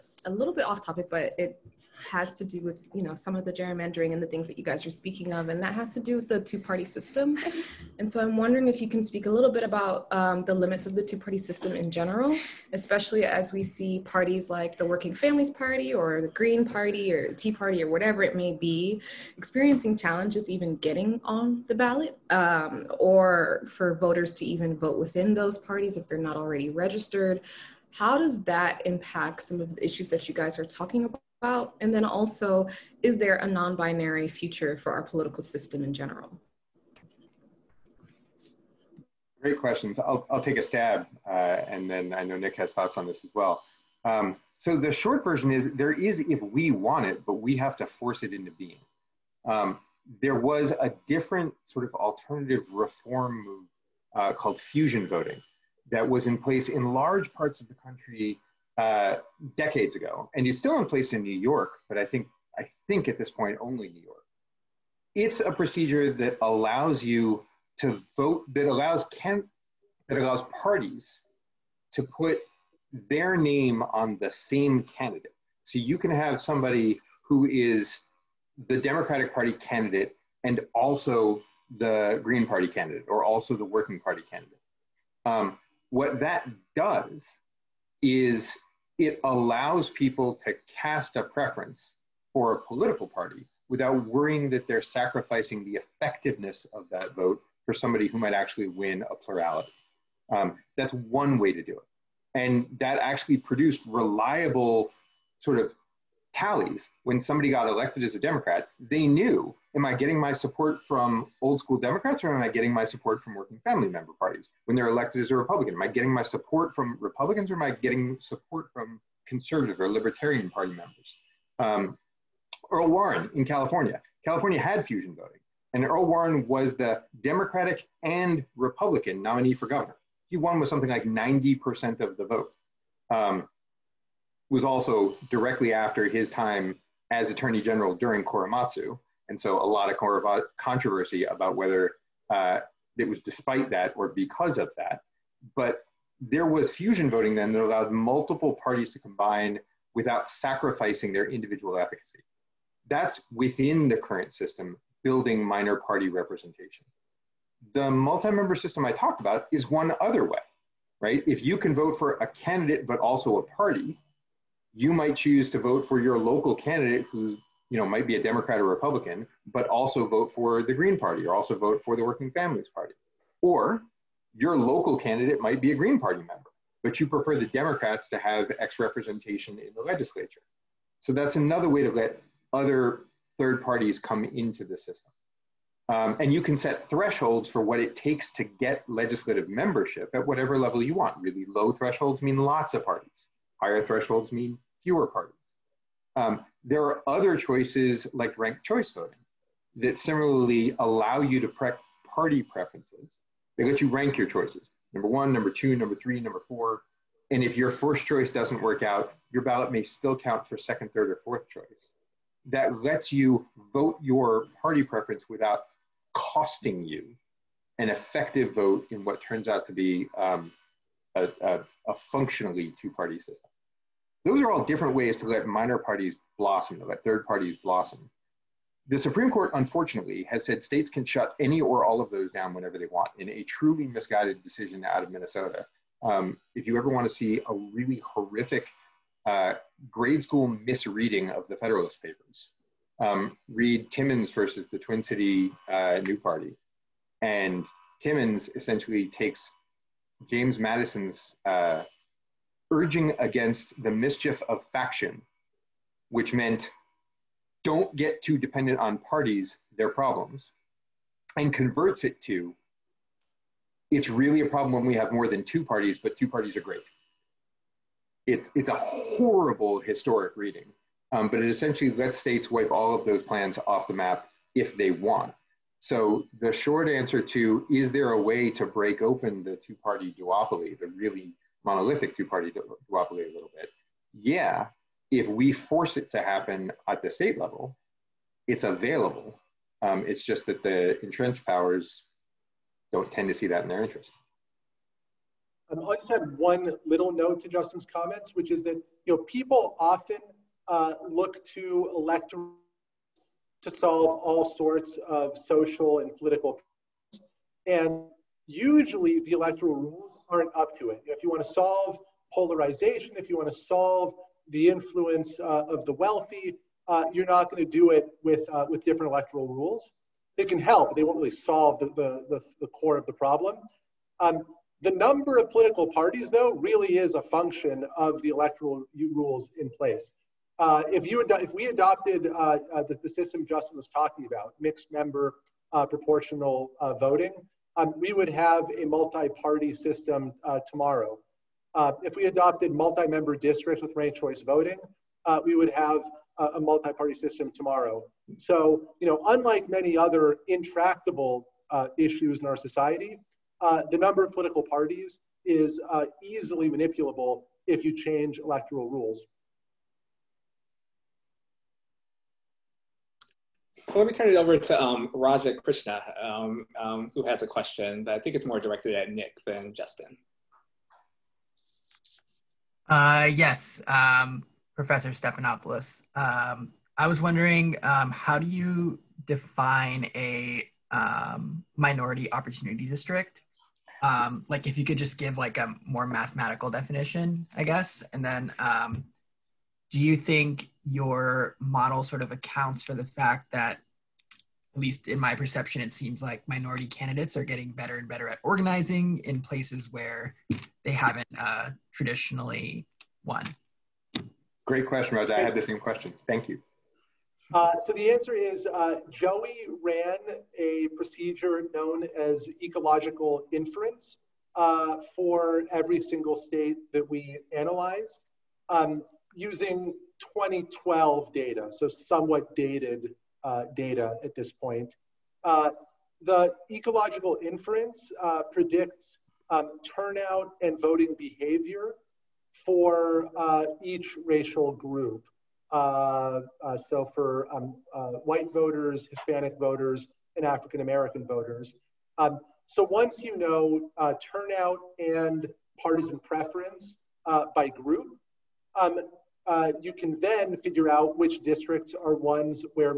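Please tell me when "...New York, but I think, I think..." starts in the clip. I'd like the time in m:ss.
1:01.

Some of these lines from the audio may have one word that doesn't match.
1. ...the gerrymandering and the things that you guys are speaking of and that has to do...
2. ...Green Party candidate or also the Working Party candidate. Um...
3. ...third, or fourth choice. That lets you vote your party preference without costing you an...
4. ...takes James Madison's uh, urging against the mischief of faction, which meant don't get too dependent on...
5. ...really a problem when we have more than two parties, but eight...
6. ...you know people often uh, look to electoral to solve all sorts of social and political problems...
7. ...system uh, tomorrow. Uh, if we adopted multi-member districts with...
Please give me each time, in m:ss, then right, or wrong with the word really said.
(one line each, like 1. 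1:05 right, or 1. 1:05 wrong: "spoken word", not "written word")
1. 0:03 right
2. 1:22 right
3. 3:30 right
4. 4:09 right
5. 4:24 wrong: "two", not "eight"
6. 4:59 right
7. 5:39 right.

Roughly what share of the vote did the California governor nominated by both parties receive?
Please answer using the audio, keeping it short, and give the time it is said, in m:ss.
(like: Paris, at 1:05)
90%, at 2:11.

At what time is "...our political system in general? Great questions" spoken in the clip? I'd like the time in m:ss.
0:34.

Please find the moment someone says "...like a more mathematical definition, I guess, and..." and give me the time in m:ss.
6:25.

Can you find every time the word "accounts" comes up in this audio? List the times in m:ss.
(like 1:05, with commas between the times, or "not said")
6:32.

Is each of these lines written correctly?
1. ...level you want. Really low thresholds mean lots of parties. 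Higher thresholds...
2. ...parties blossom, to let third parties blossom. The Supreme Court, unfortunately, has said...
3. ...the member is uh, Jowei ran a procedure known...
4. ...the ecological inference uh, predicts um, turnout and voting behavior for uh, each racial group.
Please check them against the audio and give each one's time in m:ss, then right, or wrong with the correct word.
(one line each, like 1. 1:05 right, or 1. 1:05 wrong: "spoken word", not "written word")
1. 3:10 right
2. 3:45 right
3. 6:47 wrong: "answer", not "member"
4. 7:06 right.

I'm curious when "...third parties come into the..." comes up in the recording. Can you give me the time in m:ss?
3:03.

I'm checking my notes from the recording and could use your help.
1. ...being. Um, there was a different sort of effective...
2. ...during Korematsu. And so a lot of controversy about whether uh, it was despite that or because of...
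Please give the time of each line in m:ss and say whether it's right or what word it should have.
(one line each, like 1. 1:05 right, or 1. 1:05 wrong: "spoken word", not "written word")
1. 0:48 wrong: "alternative", not "effective"
2. 2:17 right.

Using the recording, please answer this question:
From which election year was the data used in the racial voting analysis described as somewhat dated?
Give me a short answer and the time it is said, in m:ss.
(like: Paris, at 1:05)
2012, at 7:00.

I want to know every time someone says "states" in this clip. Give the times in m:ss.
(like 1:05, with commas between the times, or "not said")
3:50, 4:32, 4:47, 6:56.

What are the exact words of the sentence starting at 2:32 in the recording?
That's within the current system, building minor party representation.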